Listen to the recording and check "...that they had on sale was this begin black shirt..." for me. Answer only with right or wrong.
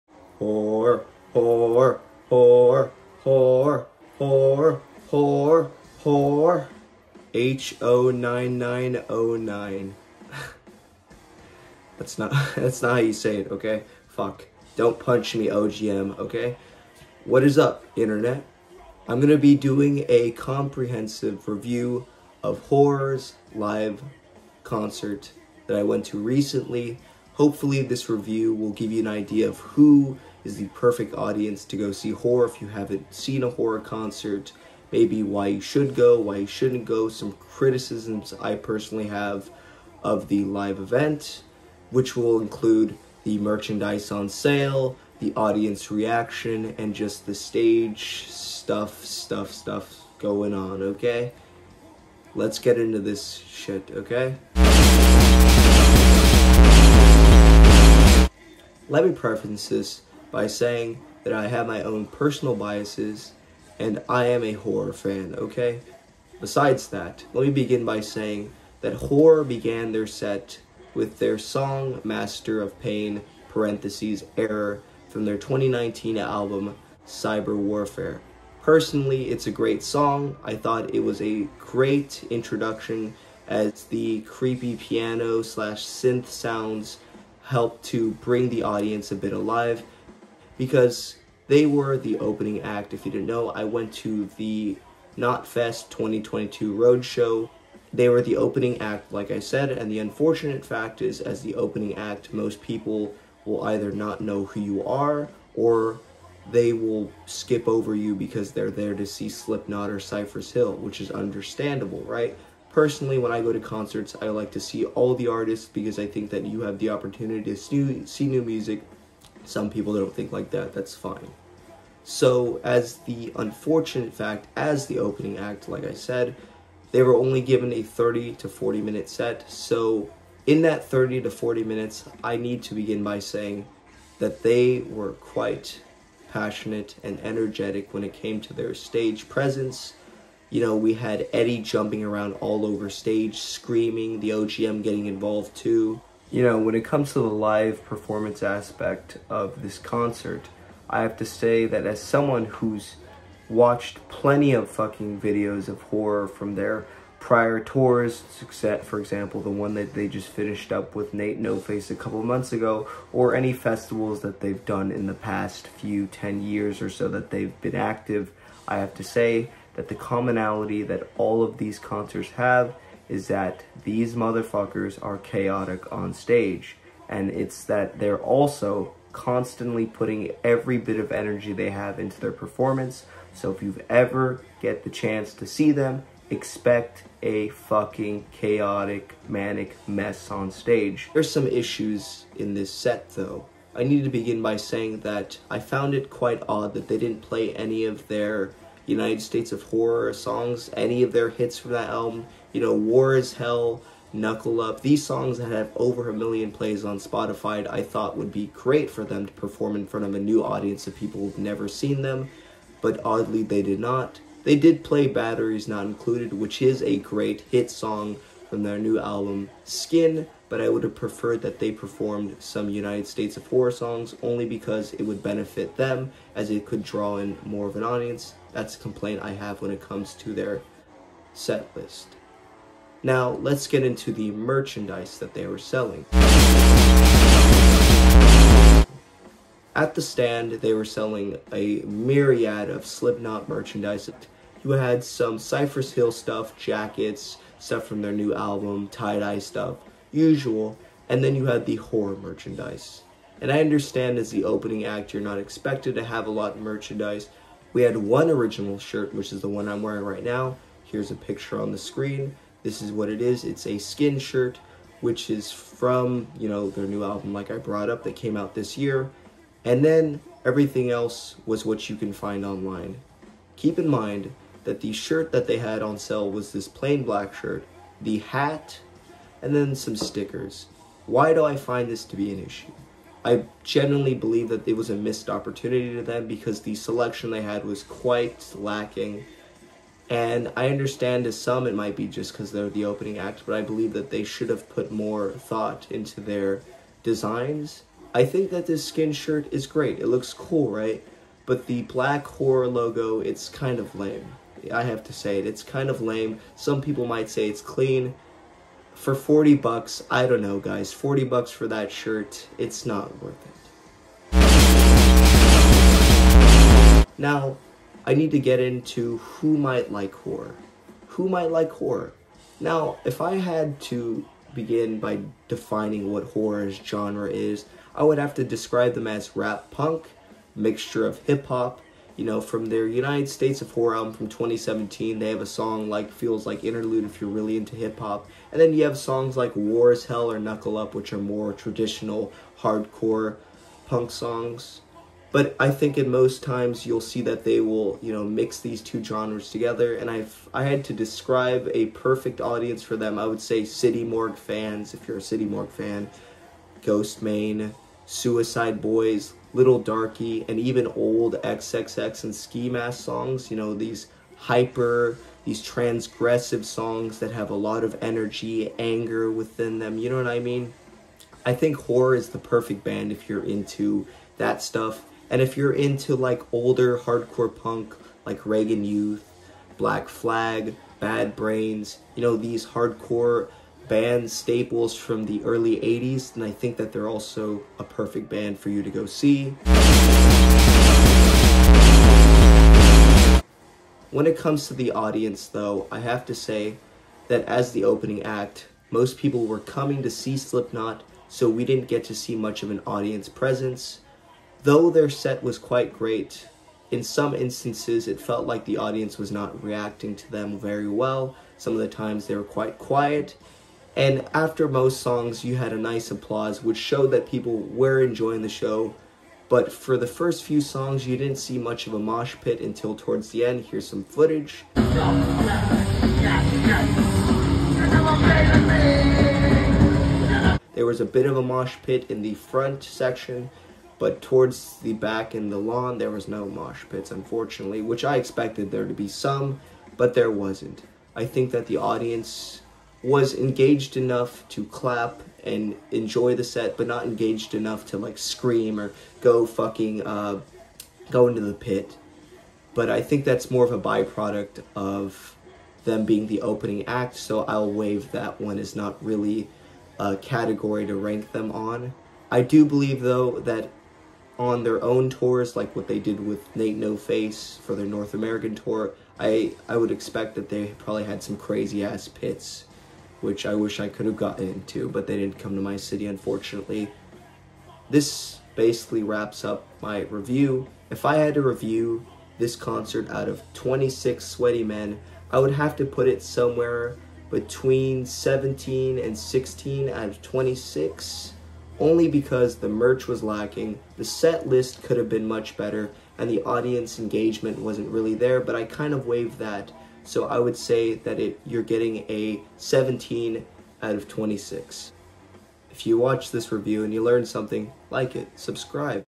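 wrong.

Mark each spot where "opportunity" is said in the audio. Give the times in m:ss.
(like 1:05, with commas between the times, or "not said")
1:56, 4:45.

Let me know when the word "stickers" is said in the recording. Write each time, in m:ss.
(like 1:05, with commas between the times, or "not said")
4:39.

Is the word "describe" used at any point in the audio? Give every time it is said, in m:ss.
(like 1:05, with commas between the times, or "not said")
5:28, 5:50.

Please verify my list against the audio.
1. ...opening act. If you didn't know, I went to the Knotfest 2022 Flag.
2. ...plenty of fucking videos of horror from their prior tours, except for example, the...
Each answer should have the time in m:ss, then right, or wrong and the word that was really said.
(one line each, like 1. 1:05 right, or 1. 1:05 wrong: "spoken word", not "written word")
1. 1:32 wrong: "Roadshow", not "Flag"
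2. 2:34 right.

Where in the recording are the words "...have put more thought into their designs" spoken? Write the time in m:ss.
4:54.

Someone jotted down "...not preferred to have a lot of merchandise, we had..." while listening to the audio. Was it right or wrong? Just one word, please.
wrong.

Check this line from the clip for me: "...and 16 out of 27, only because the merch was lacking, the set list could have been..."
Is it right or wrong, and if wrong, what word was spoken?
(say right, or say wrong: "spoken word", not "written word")
wrong: "26", not "27".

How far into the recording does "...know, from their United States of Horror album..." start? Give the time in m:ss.
5:32.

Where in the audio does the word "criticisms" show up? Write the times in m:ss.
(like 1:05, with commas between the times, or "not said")
0:37.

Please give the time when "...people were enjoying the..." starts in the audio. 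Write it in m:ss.
6:57.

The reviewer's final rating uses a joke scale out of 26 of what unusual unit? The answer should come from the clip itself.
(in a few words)
sweaty men.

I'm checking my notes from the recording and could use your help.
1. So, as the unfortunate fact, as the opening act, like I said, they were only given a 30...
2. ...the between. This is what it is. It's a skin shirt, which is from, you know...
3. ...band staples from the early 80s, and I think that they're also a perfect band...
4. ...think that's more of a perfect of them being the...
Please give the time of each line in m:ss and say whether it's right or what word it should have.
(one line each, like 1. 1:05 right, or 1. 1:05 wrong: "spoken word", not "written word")
1. 2:02 right
2. 4:21 wrong: "screen", not "between"
3. 6:23 right
4. 7:33 wrong: "byproduct", not "perfect".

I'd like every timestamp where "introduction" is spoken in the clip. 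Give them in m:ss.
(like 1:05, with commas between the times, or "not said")
1:22.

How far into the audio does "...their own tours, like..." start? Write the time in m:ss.
7:44.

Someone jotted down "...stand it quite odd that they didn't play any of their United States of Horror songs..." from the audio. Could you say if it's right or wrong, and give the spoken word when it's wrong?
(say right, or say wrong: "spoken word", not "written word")
wrong: "found", not "stand".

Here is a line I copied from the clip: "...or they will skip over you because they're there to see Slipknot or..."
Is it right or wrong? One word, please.
right.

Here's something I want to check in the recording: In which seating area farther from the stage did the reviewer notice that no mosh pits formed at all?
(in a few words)
the lawn.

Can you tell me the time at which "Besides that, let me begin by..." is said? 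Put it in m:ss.
1:06.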